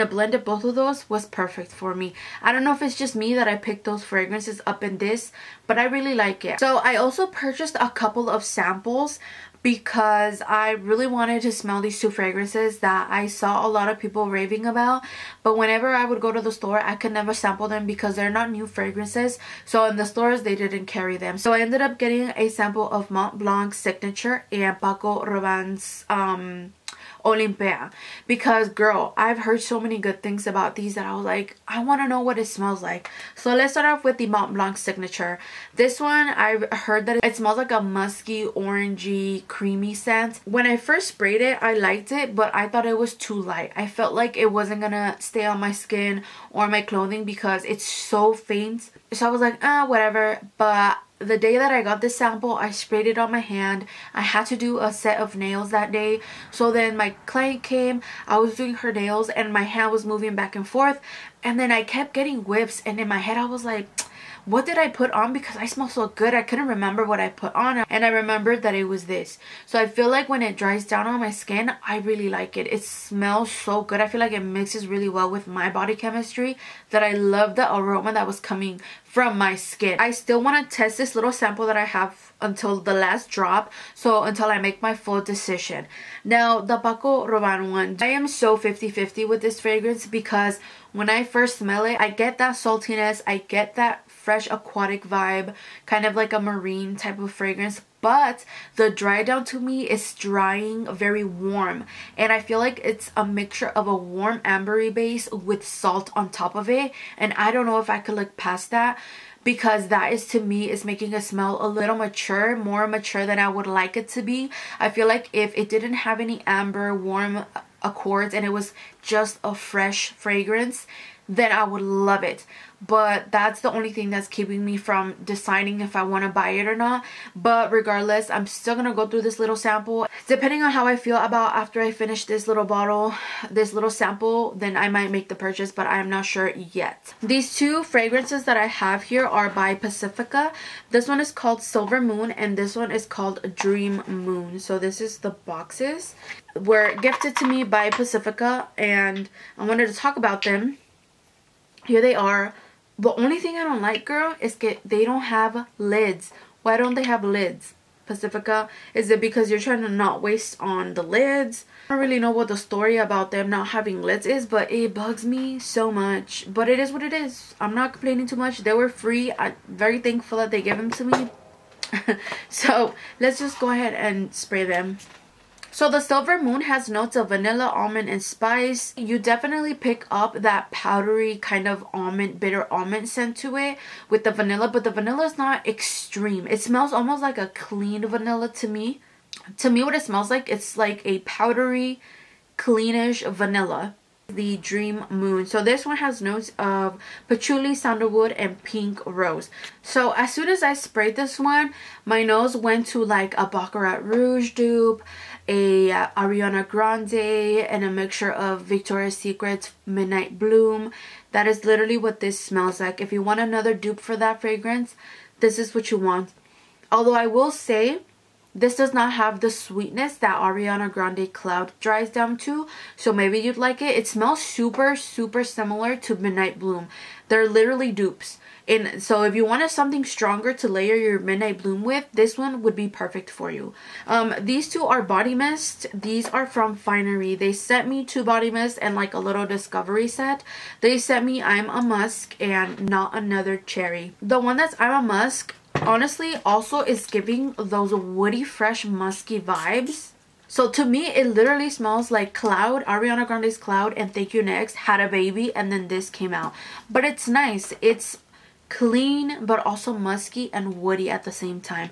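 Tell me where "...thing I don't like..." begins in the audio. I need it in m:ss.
2:33.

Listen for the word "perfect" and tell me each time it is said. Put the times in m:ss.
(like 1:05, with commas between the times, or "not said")
0:01, 3:52.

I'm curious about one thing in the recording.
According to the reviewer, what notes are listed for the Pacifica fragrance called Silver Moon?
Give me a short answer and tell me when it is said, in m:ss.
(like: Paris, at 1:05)
vanilla, almond, and spice, at 2:57.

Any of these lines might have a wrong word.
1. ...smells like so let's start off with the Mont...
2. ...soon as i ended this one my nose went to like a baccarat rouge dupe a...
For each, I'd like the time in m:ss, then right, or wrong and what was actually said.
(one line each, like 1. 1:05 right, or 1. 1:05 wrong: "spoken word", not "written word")
1. 0:32 right
2. 3:20 wrong: "sprayed", not "ended".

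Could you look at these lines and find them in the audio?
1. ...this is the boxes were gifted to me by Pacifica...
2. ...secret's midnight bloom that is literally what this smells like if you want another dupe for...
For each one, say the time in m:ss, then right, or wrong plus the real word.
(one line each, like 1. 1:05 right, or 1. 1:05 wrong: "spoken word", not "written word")
1. 2:24 right
2. 3:29 right.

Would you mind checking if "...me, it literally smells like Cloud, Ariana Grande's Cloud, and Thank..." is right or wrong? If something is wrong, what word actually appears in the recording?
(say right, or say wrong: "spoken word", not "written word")
right.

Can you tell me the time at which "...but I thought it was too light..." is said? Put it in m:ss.
0:42.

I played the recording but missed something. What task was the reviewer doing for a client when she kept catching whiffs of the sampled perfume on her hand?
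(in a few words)
a set of nails.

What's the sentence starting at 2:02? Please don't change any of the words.
But that's the only thing that's keeping me from deciding if I want to buy it or not.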